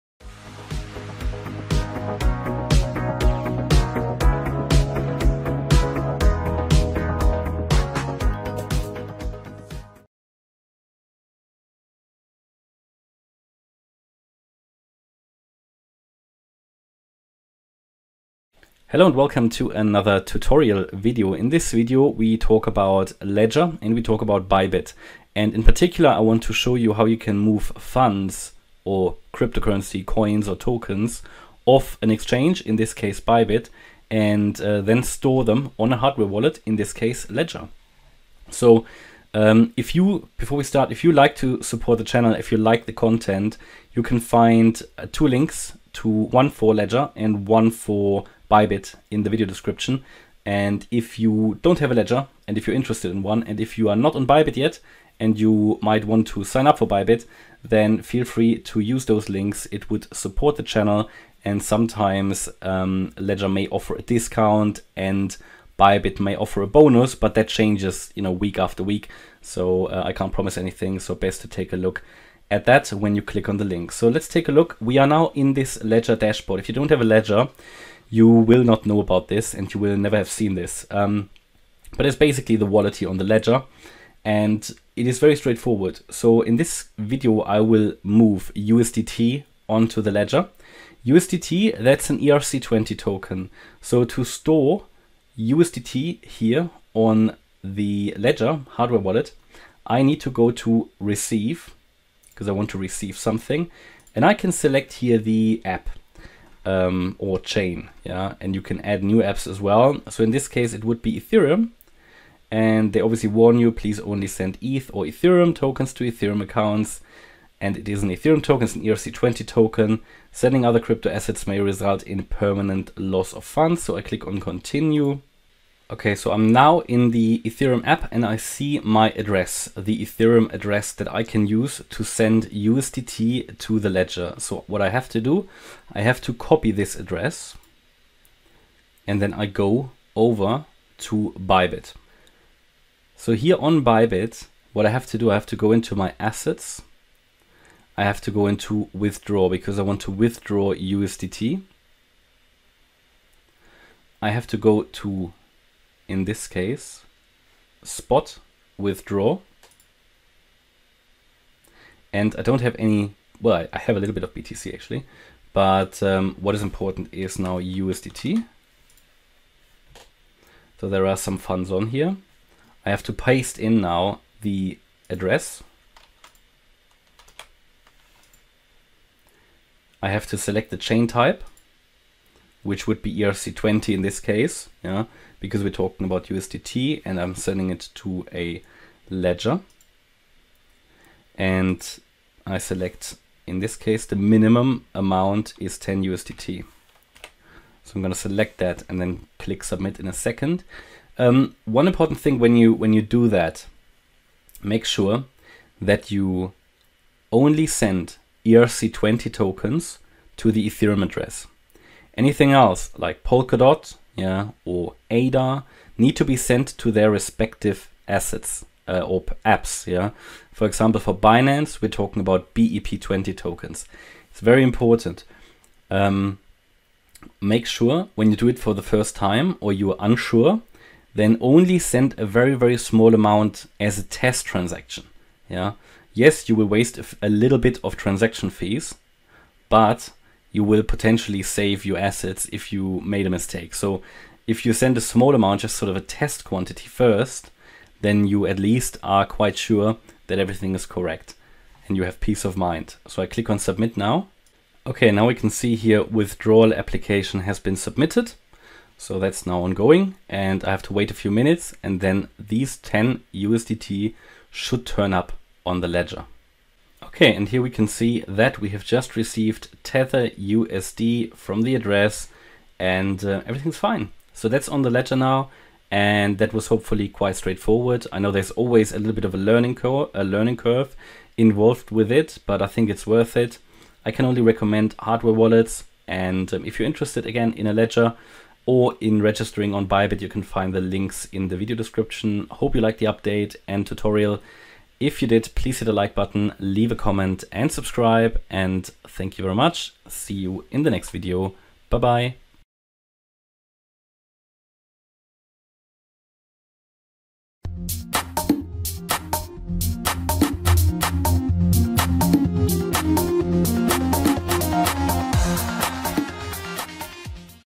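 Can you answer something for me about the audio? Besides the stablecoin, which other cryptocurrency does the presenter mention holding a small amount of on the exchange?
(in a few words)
BTC.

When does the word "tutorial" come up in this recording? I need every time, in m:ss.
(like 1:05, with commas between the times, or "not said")
0:20, 4:53.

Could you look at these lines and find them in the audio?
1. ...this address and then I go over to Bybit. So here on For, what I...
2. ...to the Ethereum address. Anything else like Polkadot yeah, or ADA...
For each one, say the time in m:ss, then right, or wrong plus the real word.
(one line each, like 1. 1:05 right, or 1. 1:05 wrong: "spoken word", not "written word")
1. 2:16 wrong: "Bybit", not "For"
2. 3:30 right.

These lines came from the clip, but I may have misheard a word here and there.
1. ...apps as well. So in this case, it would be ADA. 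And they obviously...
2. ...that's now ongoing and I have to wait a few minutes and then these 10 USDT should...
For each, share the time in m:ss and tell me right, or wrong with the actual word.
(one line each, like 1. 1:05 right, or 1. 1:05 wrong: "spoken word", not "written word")
1. 1:49 wrong: "Ethereum", not "ADA"
2. 4:19 right.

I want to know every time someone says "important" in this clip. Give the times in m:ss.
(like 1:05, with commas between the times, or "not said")
2:46, 3:21, 3:44.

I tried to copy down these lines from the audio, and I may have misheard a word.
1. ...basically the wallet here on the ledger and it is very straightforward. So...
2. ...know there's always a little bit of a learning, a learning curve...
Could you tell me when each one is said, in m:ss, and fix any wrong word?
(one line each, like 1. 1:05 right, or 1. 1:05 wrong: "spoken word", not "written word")
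1. 1:22 right
2. 4:38 right.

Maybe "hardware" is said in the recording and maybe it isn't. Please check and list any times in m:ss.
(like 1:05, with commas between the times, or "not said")
0:35, 1:38, 4:44.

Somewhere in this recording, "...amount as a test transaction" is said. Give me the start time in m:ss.
3:53.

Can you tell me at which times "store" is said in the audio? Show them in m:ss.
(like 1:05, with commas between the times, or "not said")
0:35, 1:34.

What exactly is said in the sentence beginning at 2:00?
Sending other crypto assets may result in permanent loss of funds.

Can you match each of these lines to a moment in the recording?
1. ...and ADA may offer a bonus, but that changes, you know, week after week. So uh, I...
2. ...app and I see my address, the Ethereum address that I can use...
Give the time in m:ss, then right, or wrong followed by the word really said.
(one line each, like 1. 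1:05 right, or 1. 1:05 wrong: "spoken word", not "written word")
1. 1:04 wrong: "Bybit", not "ADA"
2. 2:07 right.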